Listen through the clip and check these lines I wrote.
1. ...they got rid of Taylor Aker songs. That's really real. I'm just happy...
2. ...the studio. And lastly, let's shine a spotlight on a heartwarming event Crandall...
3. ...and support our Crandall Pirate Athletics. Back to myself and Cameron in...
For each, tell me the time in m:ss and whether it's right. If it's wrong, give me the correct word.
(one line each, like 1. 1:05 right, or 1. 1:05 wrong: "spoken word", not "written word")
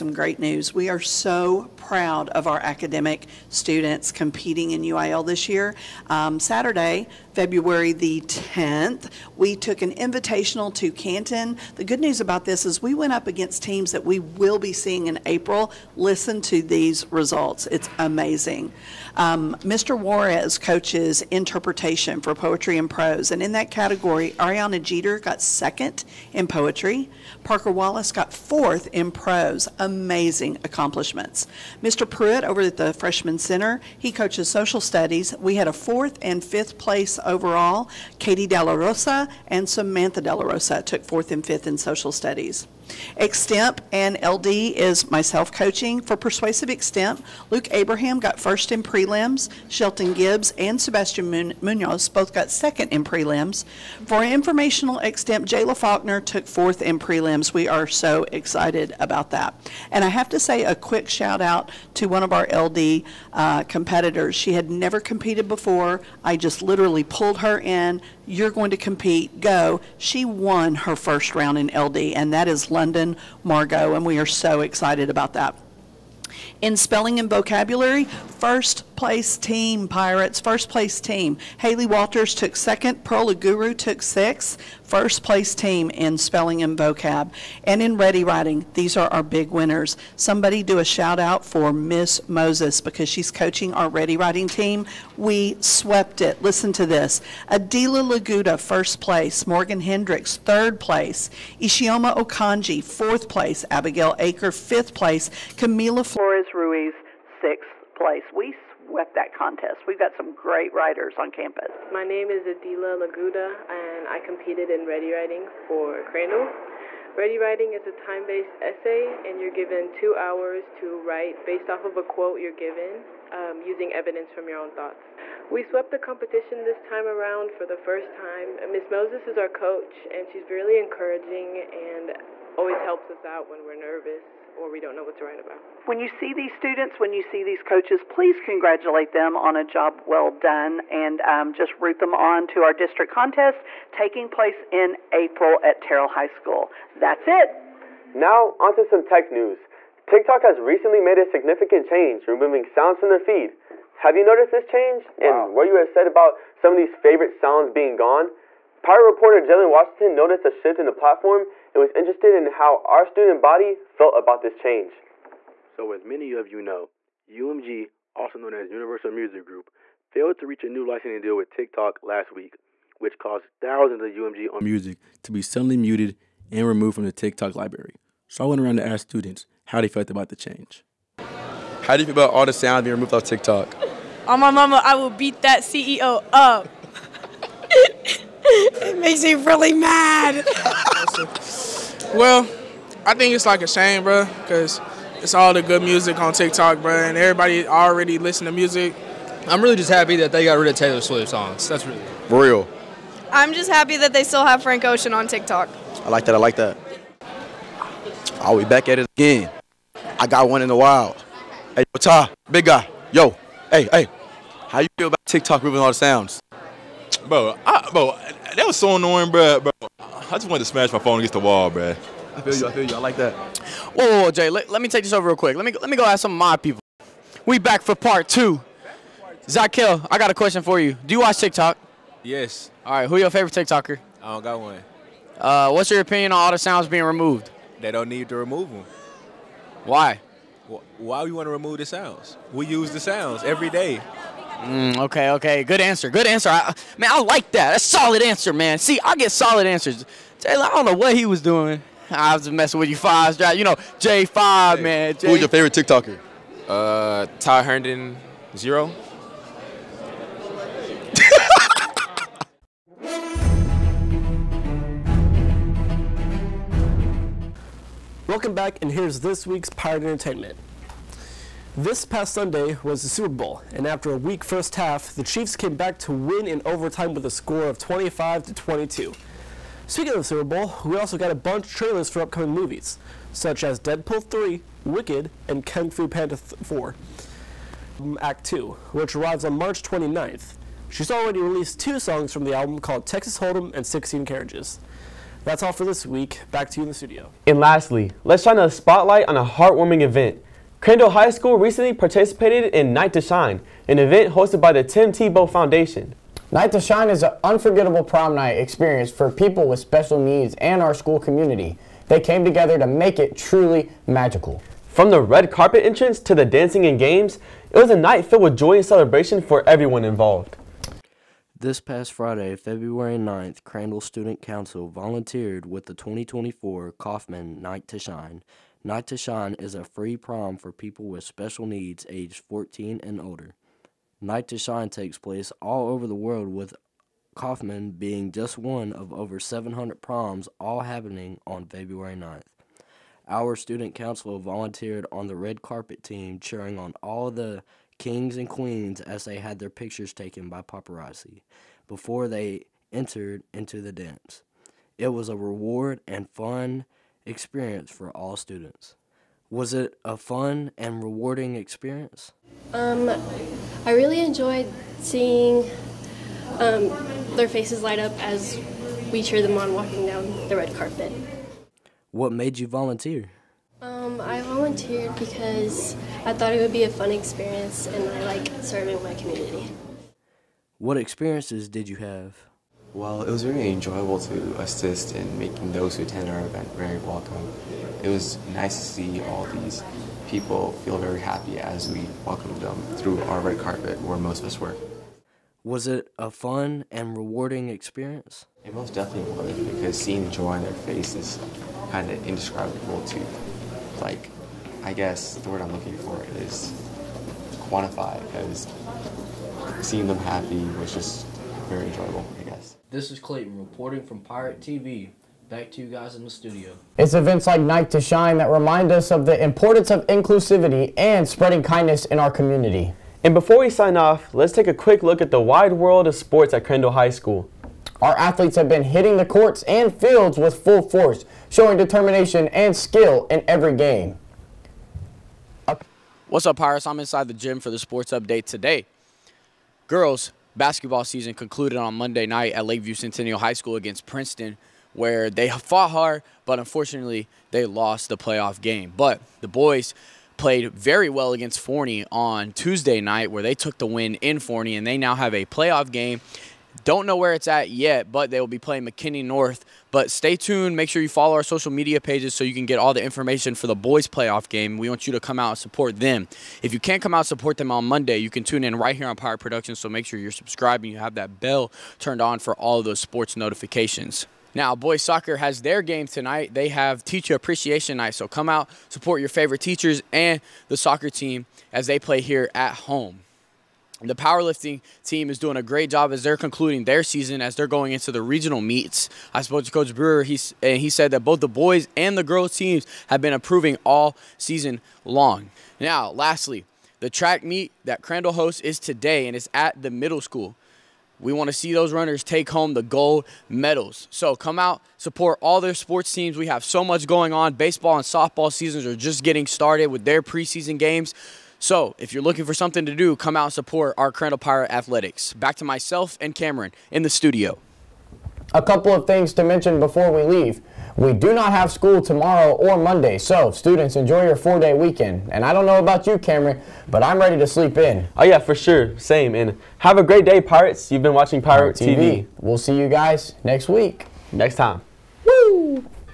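1. 3:20 wrong: "Swift", not "Aker"
2. 4:56 right
3. 8:33 right.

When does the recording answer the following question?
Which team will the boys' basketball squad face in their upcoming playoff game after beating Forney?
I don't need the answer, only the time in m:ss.
7:38.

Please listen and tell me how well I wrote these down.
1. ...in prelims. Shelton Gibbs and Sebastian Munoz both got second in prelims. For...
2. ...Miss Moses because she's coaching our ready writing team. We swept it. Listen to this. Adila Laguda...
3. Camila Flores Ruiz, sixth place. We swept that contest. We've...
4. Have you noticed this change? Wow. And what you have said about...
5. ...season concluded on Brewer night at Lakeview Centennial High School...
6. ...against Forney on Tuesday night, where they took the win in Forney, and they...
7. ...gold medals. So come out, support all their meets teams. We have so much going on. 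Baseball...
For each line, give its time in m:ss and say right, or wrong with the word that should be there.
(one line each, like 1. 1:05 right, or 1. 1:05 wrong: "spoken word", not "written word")
1. 0:48 right
2. 1:31 right
3. 1:45 right
4. 2:33 right
5. 7:21 wrong: "Monday", not "Brewer"
6. 7:31 right
7. 8:22 wrong: "sports", not "meets".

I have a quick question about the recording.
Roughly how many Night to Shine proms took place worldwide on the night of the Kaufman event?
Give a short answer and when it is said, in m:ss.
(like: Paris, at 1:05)
over 700, at 5:39.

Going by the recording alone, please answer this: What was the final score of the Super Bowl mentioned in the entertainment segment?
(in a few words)
25 to 22.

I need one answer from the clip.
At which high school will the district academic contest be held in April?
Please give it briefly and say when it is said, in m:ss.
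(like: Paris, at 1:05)
Terrell High School, at 2:25.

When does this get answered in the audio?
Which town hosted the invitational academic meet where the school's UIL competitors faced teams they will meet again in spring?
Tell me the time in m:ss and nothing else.
0:10.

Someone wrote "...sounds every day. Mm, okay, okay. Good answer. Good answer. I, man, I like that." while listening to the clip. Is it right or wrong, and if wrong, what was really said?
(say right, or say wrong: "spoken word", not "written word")
right.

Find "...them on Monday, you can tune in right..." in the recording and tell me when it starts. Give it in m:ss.
7:47.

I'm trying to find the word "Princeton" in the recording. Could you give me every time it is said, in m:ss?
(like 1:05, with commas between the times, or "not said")
7:24.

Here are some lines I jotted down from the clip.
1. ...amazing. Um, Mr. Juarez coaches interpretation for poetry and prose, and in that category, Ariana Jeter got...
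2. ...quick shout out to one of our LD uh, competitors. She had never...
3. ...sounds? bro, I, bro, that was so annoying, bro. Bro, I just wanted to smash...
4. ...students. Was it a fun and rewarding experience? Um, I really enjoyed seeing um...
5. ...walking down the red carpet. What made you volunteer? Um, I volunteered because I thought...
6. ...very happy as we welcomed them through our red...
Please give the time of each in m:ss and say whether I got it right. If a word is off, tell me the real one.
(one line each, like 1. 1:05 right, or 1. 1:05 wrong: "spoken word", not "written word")
1. 0:17 right
2. 1:00 right
3. 3:35 right
4. 5:58 right
5. 6:09 right
6. 6:30 right.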